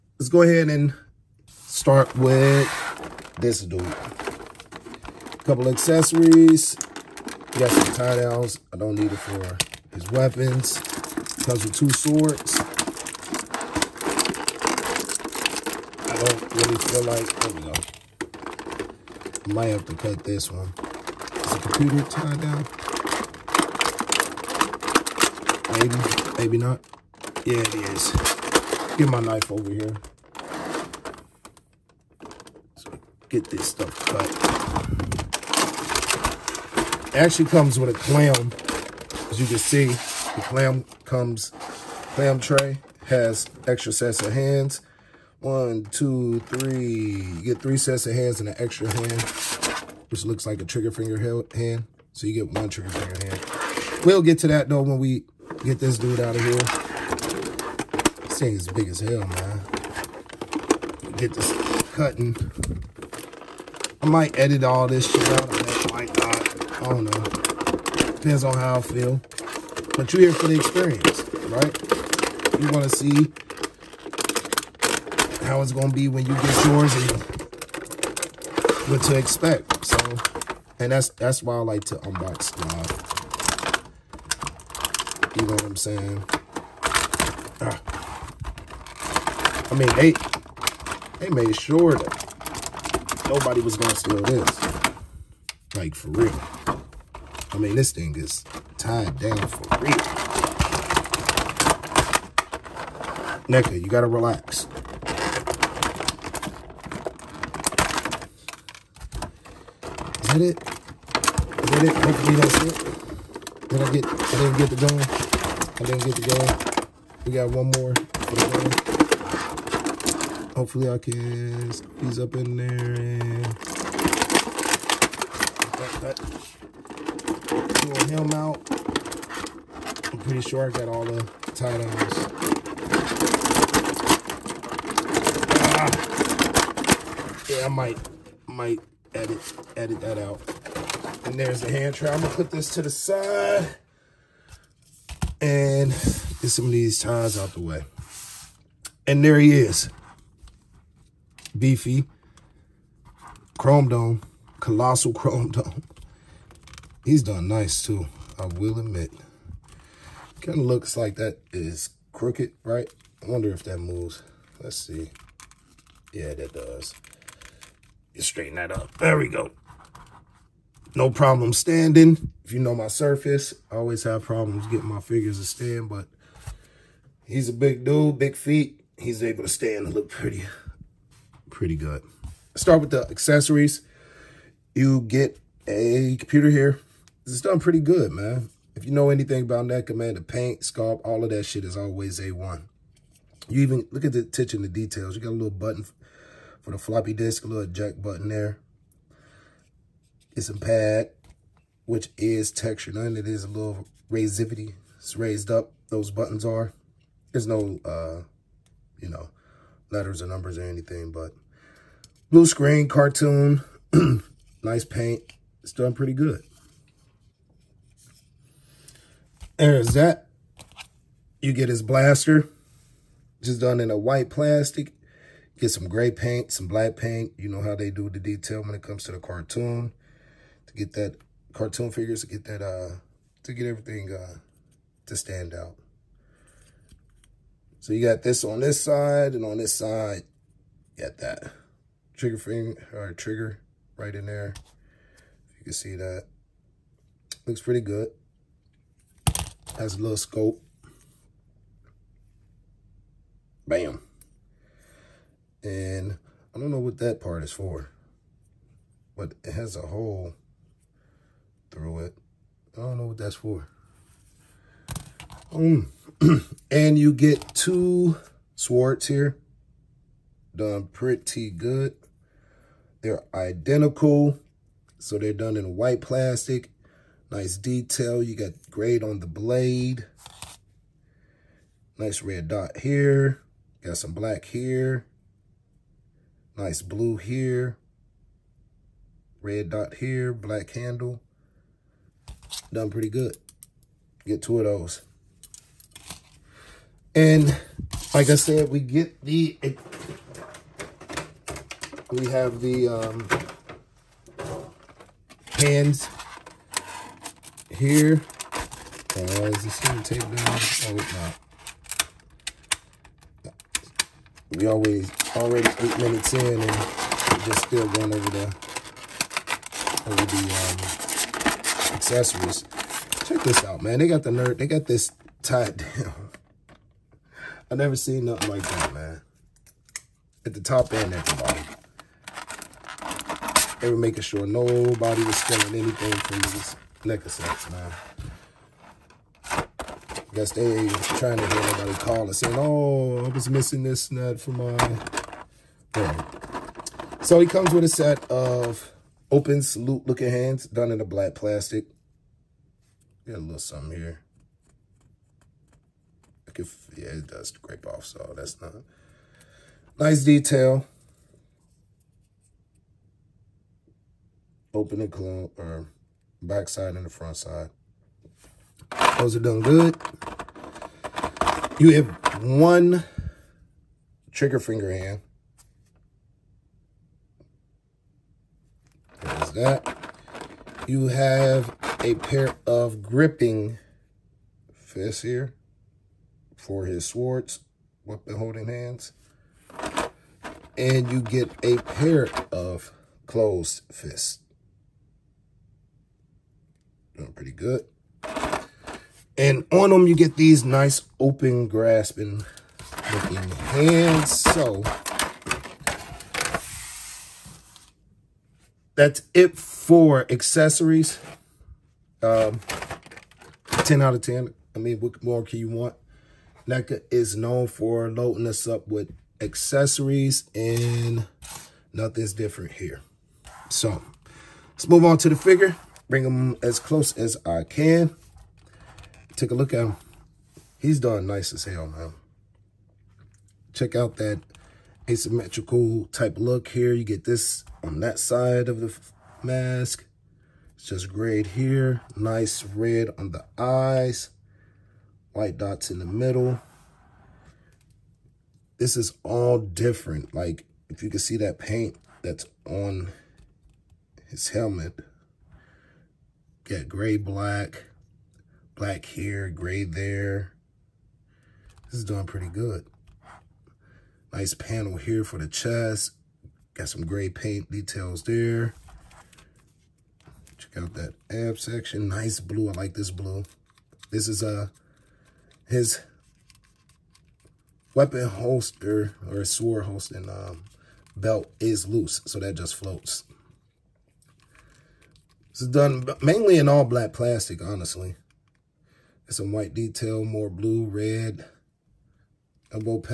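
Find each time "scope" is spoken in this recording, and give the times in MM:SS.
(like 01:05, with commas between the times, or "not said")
04:10.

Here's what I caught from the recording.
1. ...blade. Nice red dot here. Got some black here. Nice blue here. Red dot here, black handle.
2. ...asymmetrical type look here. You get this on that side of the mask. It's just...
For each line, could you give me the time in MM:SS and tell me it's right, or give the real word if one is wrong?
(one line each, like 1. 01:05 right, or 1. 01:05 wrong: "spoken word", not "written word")
1. 04:39 right
2. 07:15 right.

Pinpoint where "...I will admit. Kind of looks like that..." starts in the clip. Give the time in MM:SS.
02:38.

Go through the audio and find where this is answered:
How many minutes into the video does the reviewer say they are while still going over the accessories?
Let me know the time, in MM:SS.
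05:15.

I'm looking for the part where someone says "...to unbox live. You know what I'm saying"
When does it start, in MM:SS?
01:21.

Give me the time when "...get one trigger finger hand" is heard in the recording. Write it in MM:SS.
00:52.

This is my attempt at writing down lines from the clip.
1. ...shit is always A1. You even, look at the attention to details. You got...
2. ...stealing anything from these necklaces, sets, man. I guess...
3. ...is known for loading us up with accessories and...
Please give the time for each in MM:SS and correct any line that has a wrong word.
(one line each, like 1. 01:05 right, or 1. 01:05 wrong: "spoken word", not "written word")
1. 03:11 right
2. 05:35 right
3. 06:57 right.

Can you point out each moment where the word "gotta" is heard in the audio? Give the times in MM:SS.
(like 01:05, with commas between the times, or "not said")
01:43.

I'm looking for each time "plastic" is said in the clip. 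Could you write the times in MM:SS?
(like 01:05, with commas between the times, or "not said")
03:44, 04:35, 05:51, 08:07.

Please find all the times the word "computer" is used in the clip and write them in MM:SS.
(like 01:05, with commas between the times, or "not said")
00:21, 03:06.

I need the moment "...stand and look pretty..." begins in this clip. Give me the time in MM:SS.
02:59.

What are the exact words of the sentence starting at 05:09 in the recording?
Uh, is this going tape down?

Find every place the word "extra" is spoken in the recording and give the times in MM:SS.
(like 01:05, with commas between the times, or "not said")
00:43, 00:48.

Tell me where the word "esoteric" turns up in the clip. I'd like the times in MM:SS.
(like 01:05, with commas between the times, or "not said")
not said.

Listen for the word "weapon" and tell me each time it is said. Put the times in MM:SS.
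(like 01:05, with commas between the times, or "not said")
00:10, 06:28, 07:57.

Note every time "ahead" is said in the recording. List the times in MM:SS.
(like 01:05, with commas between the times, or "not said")
00:00.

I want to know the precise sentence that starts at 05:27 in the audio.
I never seen nothing like that, man.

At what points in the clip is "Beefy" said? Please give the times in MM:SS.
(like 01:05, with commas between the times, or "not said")
02:31.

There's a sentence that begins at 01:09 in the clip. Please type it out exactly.
But you're here for the experience, right?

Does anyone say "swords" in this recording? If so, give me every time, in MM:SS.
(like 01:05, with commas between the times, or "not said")
00:11, 04:28, 06:27, 07:59.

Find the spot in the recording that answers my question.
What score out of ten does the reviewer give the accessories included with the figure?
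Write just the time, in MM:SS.
06:53.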